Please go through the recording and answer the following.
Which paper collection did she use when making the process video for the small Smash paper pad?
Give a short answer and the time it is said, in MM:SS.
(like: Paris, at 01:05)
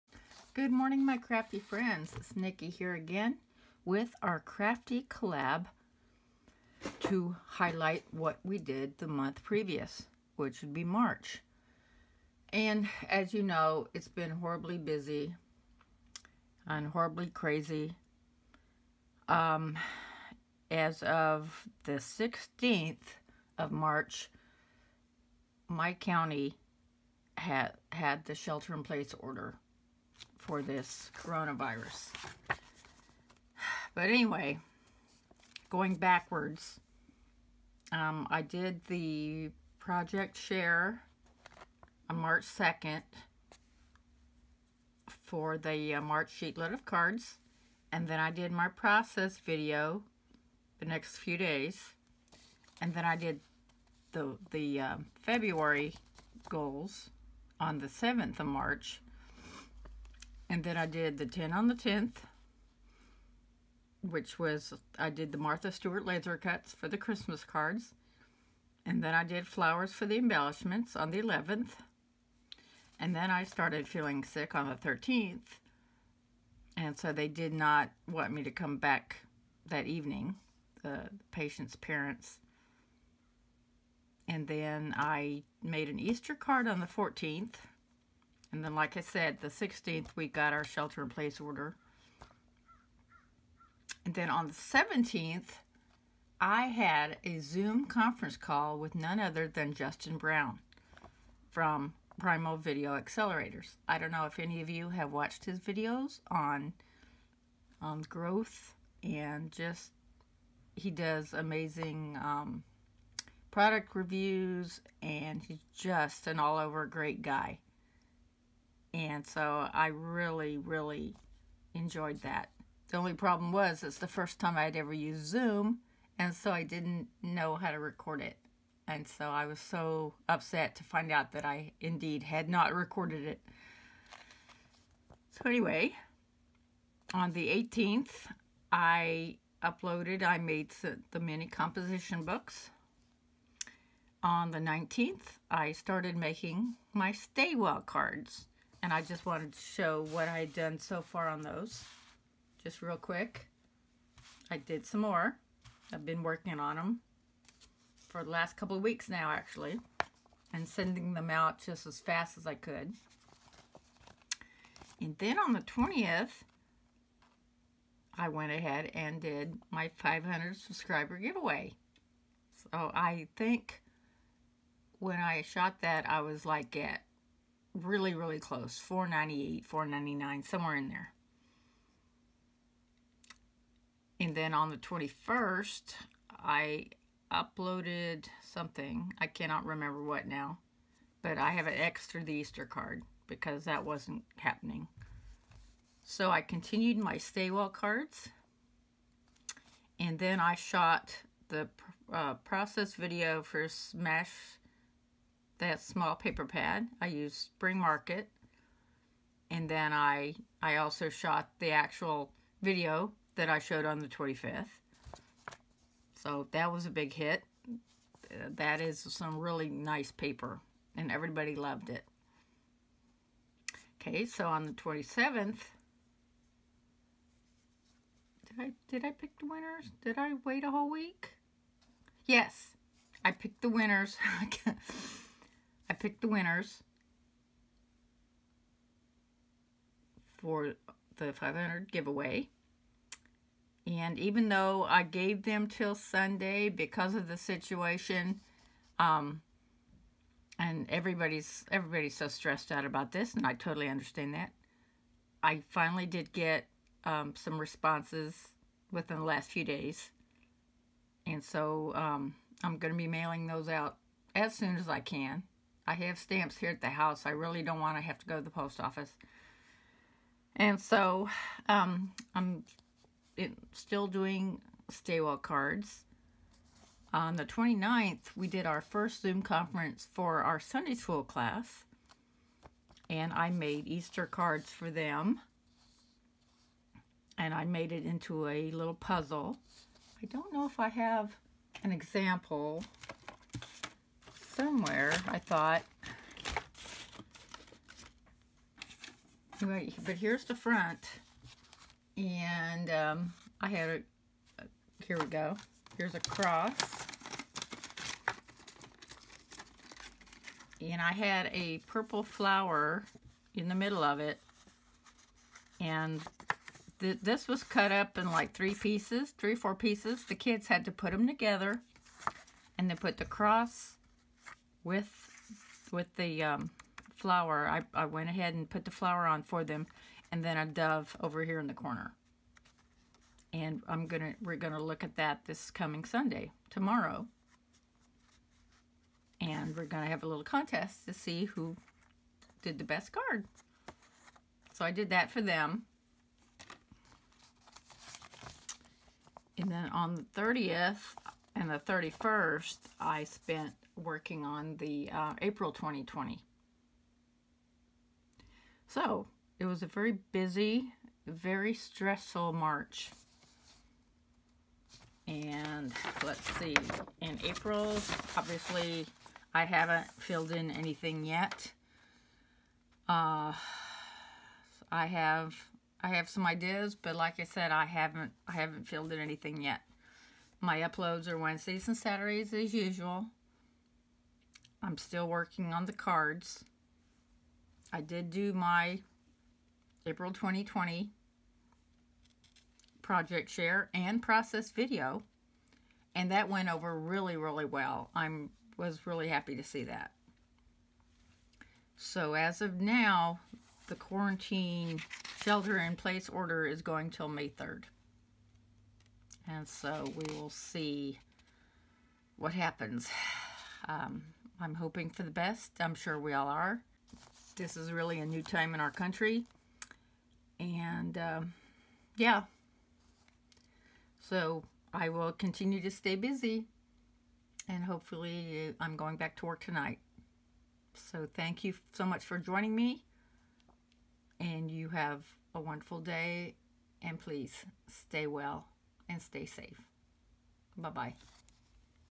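Spring Market, at 03:27.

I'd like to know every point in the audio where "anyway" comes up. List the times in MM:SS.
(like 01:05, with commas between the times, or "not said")
00:34, 02:15.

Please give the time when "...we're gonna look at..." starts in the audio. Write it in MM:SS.
05:34.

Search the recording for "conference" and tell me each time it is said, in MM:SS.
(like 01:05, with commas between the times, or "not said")
01:37, 04:39.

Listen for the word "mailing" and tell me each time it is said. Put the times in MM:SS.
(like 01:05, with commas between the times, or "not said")
04:23.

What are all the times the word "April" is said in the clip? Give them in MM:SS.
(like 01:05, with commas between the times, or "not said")
05:55, 06:07, 06:30.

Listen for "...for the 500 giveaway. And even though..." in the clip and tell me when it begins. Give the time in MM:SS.
04:00.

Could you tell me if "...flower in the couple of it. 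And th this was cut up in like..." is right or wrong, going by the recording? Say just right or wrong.
wrong.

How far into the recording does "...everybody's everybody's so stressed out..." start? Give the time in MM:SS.
04:10.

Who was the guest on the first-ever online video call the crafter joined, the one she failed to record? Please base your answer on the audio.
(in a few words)
Justin Brown.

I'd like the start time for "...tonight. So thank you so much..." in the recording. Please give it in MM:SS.
07:09.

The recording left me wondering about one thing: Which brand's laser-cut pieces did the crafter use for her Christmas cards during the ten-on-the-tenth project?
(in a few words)
Martha Stewart.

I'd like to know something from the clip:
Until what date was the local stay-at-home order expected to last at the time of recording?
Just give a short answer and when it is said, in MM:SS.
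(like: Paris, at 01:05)
May 3rd, at 06:47.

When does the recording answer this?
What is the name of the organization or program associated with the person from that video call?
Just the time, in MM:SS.
01:42.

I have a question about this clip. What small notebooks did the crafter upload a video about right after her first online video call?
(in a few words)
mini composition books.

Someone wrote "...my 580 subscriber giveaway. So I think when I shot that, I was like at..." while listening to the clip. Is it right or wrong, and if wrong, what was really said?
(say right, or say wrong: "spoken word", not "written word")
wrong: "500", not "580".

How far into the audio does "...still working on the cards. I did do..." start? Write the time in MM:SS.
06:24.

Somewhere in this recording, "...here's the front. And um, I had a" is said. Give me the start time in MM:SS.
05:00.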